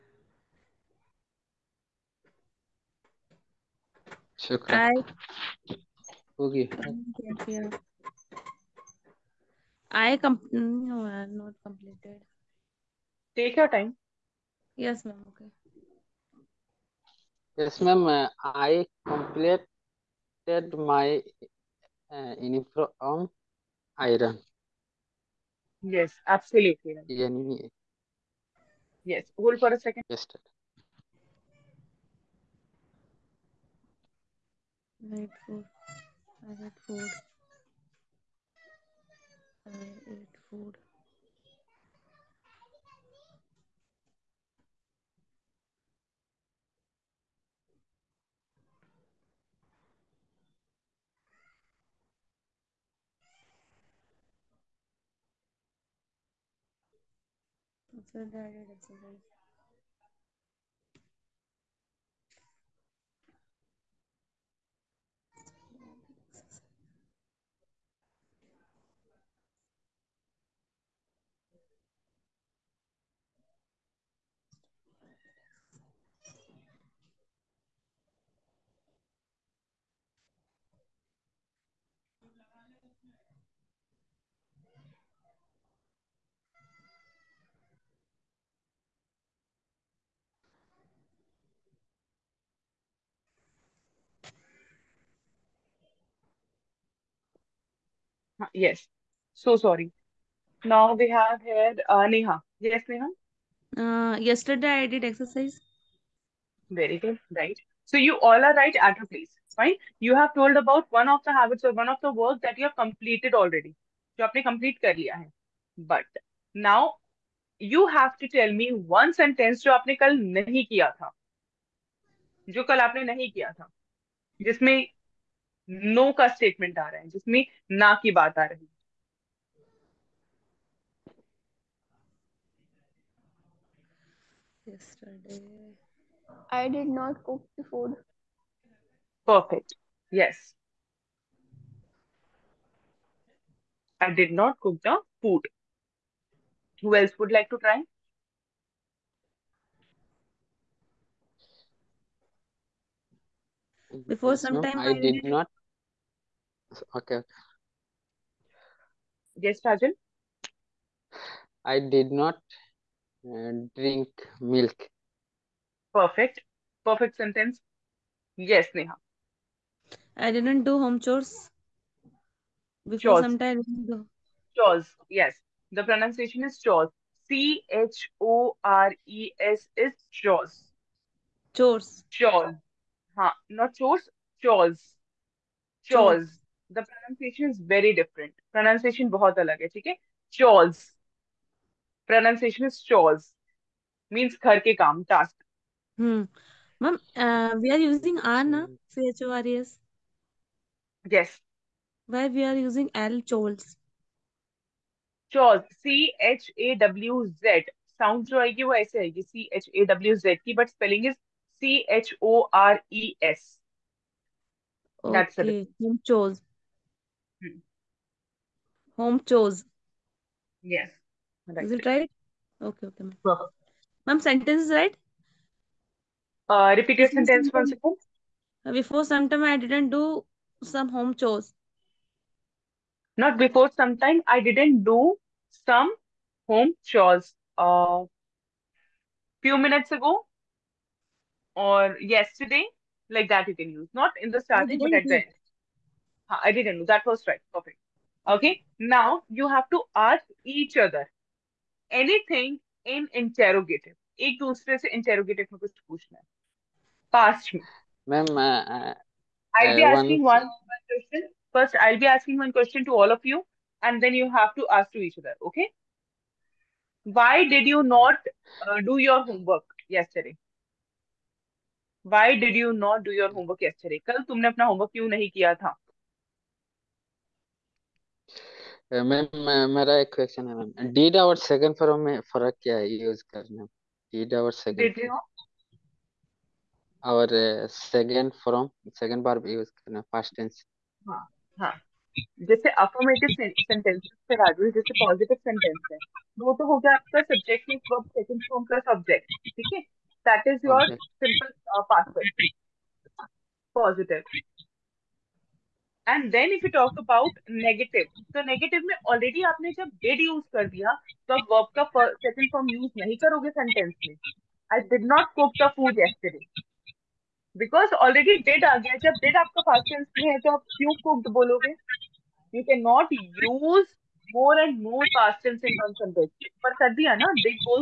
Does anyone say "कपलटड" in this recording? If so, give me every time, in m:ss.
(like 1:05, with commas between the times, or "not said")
0:11, 0:19.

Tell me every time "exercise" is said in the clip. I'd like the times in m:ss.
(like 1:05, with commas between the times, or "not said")
0:58, 1:45.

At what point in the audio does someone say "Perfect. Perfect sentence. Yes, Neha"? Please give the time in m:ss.
2:45.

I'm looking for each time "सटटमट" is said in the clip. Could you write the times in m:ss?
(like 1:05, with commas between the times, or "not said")
2:06.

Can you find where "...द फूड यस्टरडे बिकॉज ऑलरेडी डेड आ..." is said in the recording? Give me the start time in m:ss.
5:15.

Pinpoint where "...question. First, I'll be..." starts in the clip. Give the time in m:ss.
4:20.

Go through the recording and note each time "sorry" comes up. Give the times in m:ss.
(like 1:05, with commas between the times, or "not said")
1:39.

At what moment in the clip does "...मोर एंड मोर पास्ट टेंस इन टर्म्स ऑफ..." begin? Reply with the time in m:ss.
5:24.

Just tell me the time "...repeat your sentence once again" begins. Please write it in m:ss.
3:46.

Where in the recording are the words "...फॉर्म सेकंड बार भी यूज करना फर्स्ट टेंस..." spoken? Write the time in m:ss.
4:48.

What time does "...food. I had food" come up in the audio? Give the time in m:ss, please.
0:35.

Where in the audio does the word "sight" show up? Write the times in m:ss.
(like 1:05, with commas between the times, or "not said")
not said.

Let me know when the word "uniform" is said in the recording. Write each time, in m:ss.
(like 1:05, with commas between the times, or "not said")
0:22.